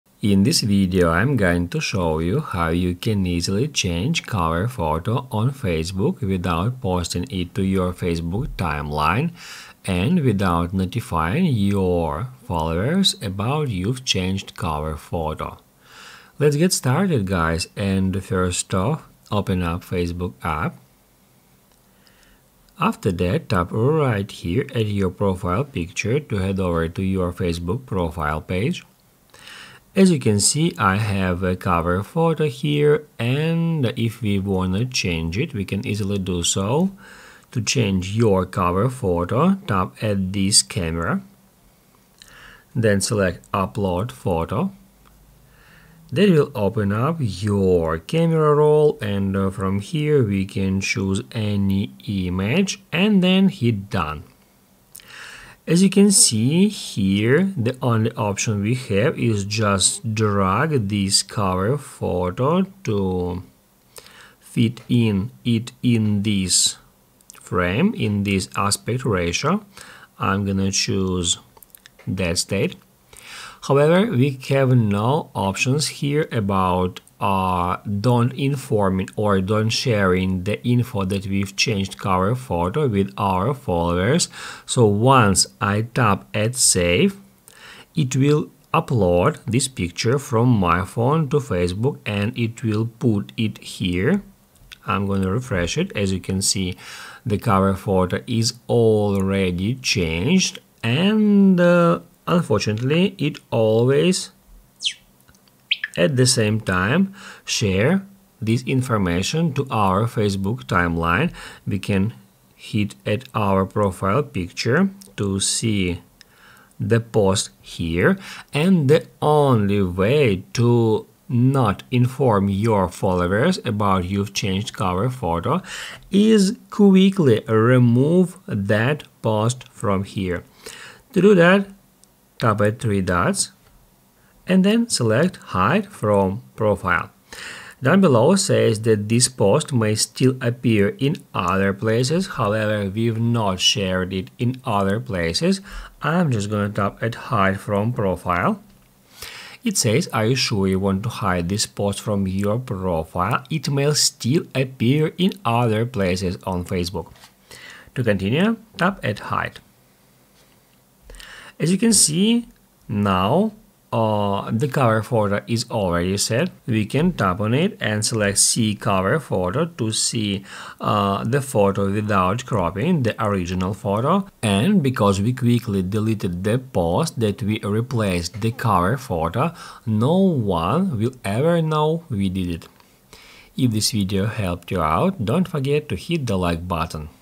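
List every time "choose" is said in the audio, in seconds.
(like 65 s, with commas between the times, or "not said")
50 s, 70 s.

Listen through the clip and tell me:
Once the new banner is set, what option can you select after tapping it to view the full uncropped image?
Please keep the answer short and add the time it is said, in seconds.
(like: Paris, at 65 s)
See cover photo, at 168 s.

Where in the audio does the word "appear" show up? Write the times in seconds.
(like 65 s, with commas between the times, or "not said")
140 s, 154 s.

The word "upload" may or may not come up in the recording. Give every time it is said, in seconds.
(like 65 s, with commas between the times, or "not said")
43 s, 88 s.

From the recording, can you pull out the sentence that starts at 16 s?
Let's get started guys and first off open up Facebook app.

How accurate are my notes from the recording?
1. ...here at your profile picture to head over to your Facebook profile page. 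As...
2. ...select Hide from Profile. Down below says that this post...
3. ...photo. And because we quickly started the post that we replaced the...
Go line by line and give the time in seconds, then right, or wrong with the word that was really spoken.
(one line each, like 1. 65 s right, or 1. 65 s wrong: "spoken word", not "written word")
1. 24 s right
2. 134 s right
3. 173 s wrong: "deleted", not "started".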